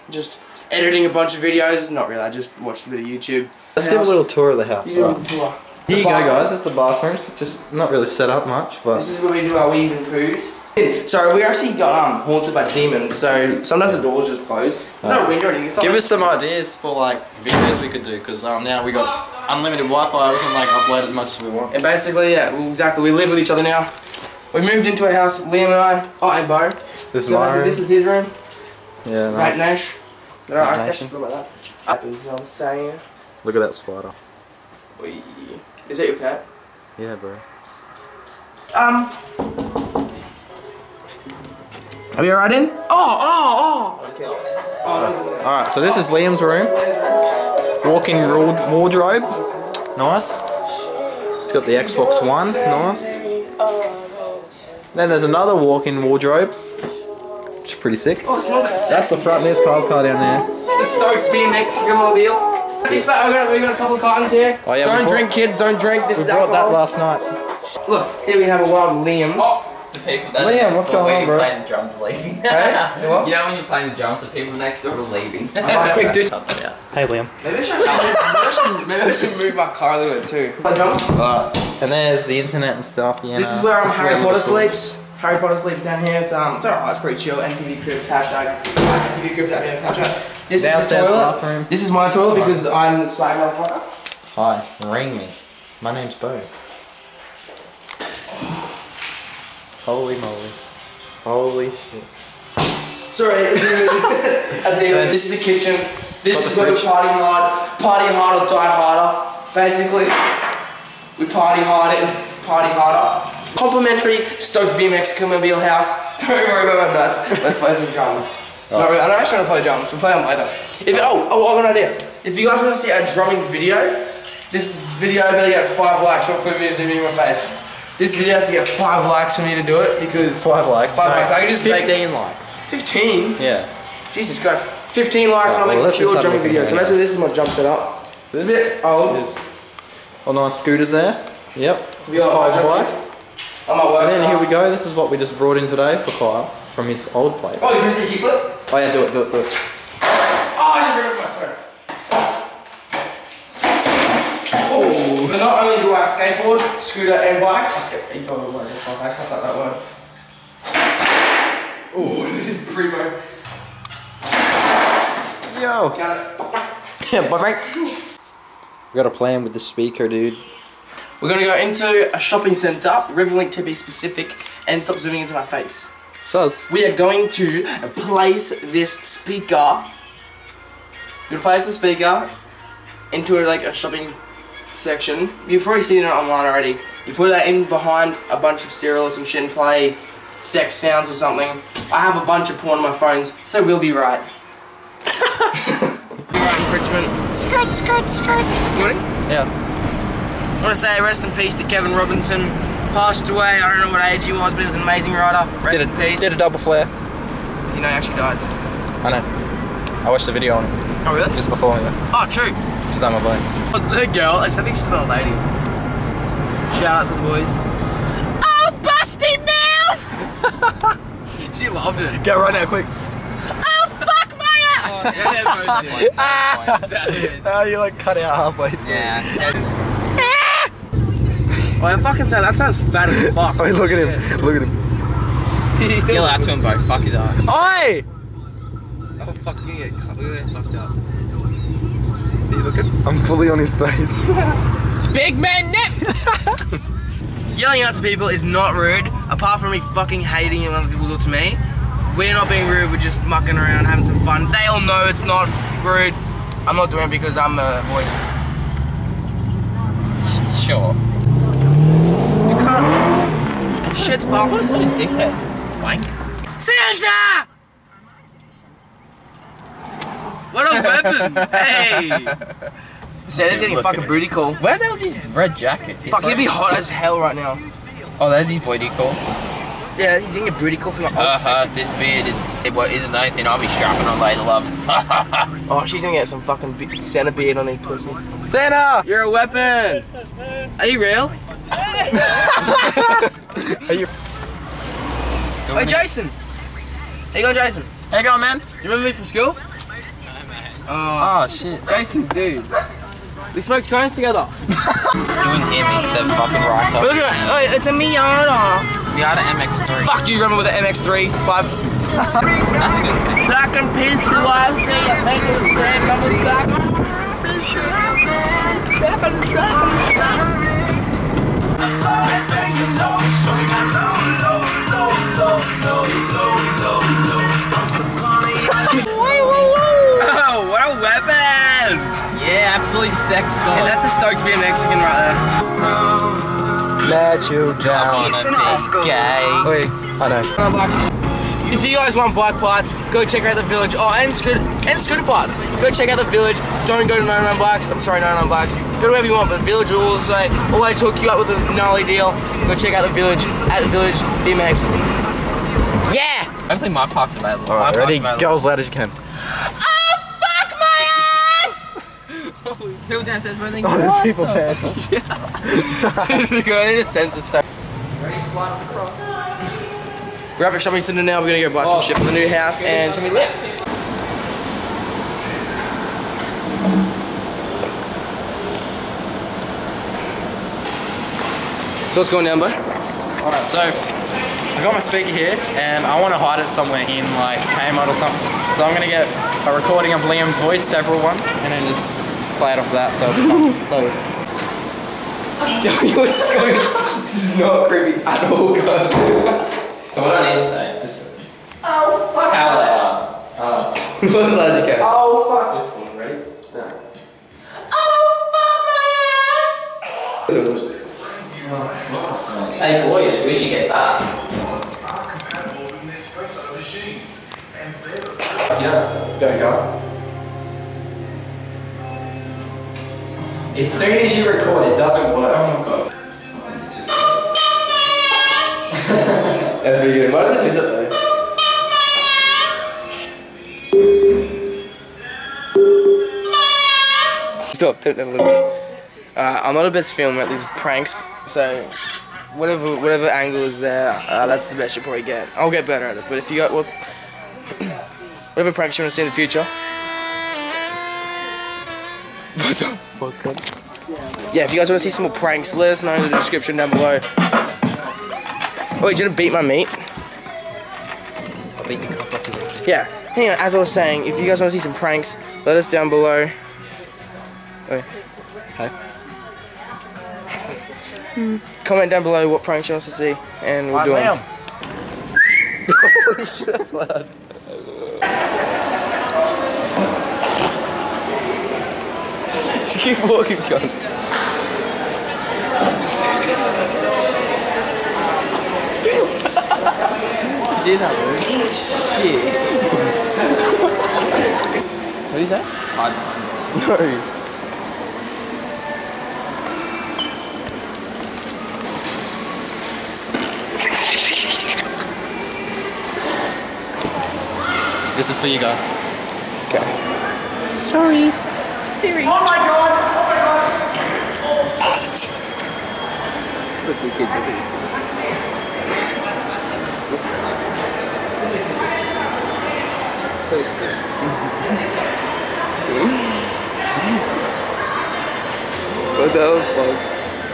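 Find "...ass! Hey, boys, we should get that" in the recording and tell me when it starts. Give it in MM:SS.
06:52.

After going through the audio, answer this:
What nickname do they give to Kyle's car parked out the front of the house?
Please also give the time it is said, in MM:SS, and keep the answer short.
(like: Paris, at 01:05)
Stoke BMX Grimobile, at 01:01.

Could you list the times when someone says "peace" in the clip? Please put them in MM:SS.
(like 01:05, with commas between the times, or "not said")
03:21, 03:25.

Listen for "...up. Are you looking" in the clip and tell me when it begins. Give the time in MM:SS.
04:00.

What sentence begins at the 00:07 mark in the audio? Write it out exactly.
Just not really set up much, but this is where we do our wees and poos.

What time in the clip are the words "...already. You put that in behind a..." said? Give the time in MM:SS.
03:06.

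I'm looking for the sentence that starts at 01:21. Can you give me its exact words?
And there's the internet and stuff, you know.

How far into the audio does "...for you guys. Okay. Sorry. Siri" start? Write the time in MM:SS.
08:28.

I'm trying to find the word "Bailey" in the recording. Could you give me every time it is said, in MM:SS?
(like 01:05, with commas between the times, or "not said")
not said.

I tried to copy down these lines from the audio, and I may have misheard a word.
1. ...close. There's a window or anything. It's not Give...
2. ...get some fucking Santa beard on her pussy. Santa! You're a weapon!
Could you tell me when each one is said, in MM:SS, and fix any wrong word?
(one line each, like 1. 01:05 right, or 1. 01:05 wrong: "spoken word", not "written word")
1. 00:14 right
2. 04:46 right.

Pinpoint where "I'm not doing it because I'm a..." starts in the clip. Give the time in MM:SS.
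04:16.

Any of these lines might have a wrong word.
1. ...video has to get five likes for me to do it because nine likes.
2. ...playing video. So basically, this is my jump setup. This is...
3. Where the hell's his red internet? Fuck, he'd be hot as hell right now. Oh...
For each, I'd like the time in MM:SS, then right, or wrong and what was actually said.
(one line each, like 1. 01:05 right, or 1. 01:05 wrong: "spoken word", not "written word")
1. 02:08 wrong: "five", not "nine"
2. 02:16 wrong: "jumping", not "playing"
3. 04:34 wrong: "jacket", not "internet".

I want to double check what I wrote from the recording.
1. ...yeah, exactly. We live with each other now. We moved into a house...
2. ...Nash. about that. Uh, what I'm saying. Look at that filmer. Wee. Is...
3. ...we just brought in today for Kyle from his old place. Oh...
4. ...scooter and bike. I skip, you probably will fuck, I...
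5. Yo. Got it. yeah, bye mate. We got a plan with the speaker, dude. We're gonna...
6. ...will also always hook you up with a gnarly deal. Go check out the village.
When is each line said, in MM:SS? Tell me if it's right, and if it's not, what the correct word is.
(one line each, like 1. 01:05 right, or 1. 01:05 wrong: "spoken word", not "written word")
1. 00:22 right
2. 00:30 wrong: "spider", not "filmer"
3. 02:25 right
4. 02:36 right
5. 02:45 right
6. 05:49 right.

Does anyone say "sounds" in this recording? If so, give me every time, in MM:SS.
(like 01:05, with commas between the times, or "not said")
03:10, 03:52.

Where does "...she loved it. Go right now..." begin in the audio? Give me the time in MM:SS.
03:41.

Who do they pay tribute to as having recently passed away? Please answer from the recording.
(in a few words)
Kevin Robinson.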